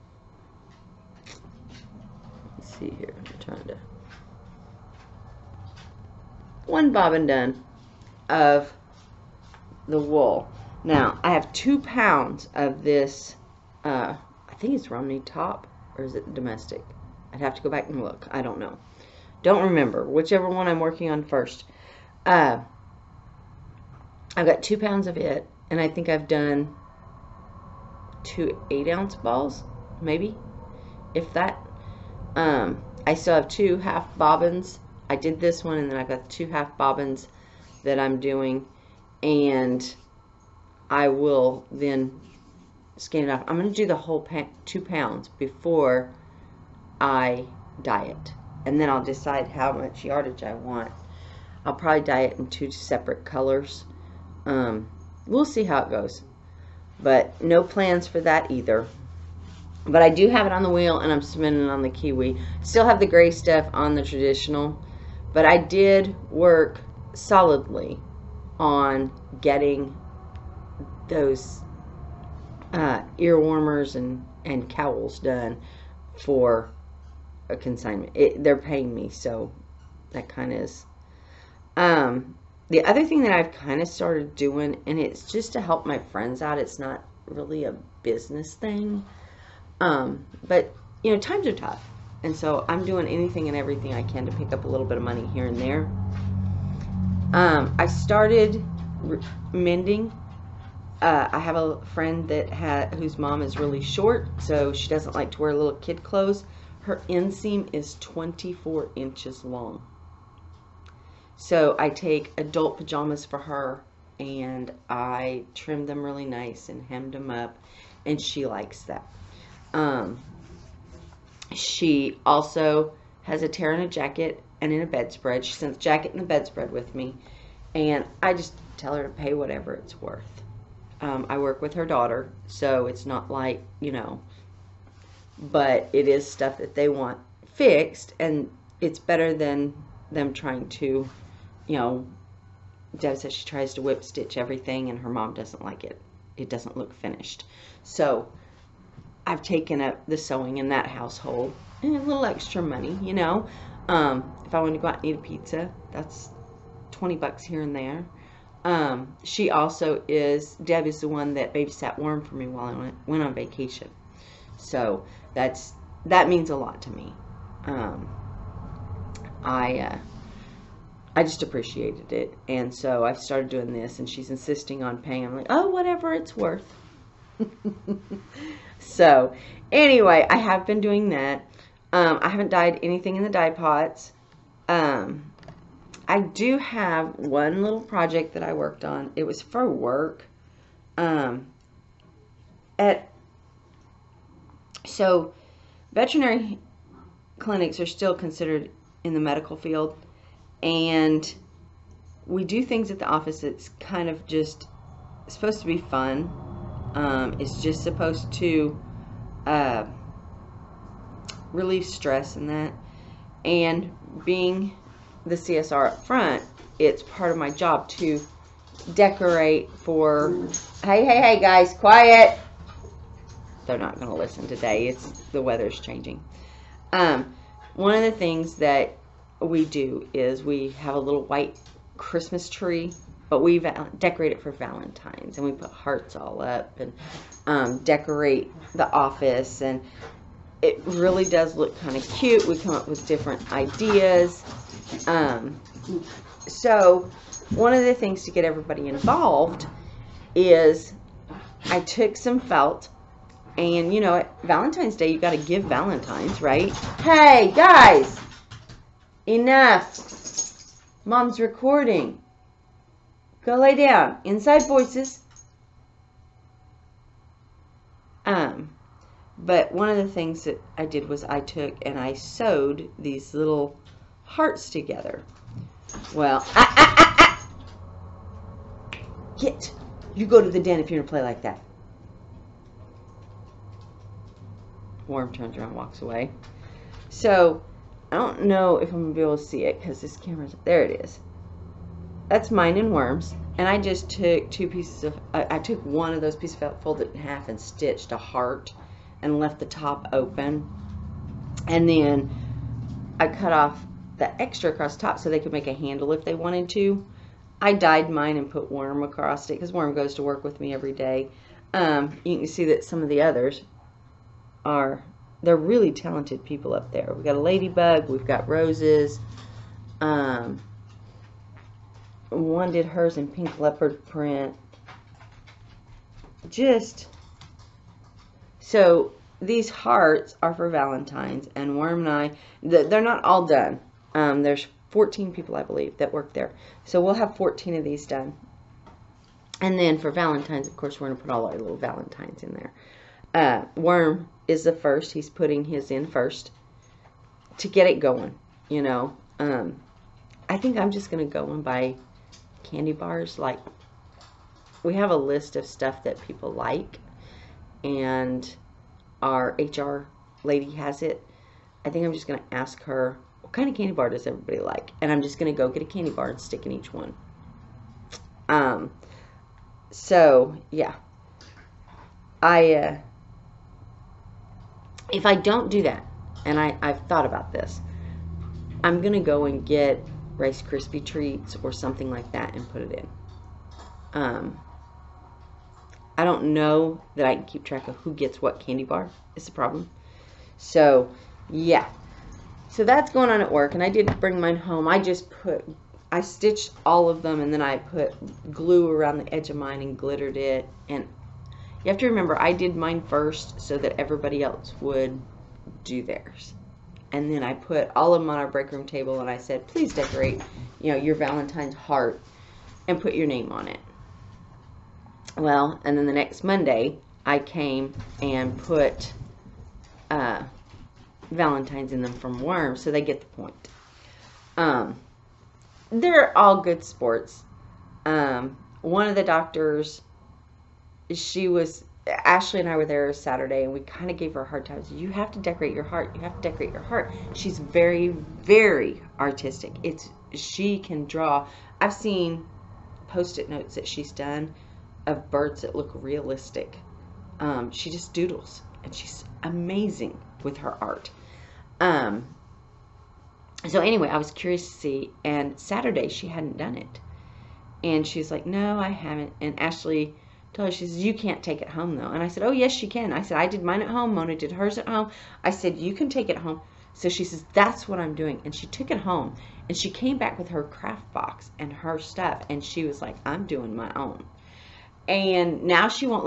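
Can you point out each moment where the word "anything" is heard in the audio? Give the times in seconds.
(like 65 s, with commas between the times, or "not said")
93 s, 182 s.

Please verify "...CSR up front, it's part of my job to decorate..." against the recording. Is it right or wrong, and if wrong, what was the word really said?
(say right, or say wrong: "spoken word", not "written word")
right.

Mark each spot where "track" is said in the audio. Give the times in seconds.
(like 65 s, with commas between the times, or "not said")
387 s.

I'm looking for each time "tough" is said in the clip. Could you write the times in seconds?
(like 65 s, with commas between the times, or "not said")
91 s.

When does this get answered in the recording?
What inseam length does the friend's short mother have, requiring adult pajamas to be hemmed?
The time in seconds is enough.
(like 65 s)
107 s.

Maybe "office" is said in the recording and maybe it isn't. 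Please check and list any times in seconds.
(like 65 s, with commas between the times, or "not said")
203 s, 238 s.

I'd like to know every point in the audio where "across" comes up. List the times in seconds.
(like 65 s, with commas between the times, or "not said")
304 s, 309 s.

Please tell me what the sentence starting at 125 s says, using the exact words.
She sends jacket and a bedspread with me, and I just tell her to pay whatever it's worth.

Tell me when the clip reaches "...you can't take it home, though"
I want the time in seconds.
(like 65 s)
461 s.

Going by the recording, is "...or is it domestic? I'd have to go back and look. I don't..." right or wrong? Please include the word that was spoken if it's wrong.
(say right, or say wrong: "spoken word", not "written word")
right.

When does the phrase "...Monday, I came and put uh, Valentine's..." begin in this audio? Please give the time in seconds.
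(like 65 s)
416 s.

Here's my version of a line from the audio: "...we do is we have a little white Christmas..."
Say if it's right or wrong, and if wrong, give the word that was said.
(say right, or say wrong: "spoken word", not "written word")
right.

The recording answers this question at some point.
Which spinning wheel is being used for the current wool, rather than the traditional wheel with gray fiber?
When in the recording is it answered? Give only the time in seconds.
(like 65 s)
61 s.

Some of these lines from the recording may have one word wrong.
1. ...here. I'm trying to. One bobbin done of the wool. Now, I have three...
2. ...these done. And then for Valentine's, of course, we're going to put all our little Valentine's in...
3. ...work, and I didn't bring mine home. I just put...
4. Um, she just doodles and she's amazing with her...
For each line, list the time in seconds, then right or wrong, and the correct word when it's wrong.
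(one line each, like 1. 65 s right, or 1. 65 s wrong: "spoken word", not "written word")
1. 2 s wrong: "two", not "three"
2. 337 s right
3. 393 s right
4. 447 s right.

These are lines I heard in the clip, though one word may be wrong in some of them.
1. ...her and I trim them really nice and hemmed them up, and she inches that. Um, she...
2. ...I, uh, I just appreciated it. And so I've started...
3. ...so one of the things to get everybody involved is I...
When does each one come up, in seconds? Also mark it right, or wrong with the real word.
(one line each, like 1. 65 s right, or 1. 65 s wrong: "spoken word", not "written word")
1. 113 s wrong: "likes", not "inches"
2. 169 s right
3. 246 s right.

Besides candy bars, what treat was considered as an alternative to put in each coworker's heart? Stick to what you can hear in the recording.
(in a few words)
Rice Krispie treats.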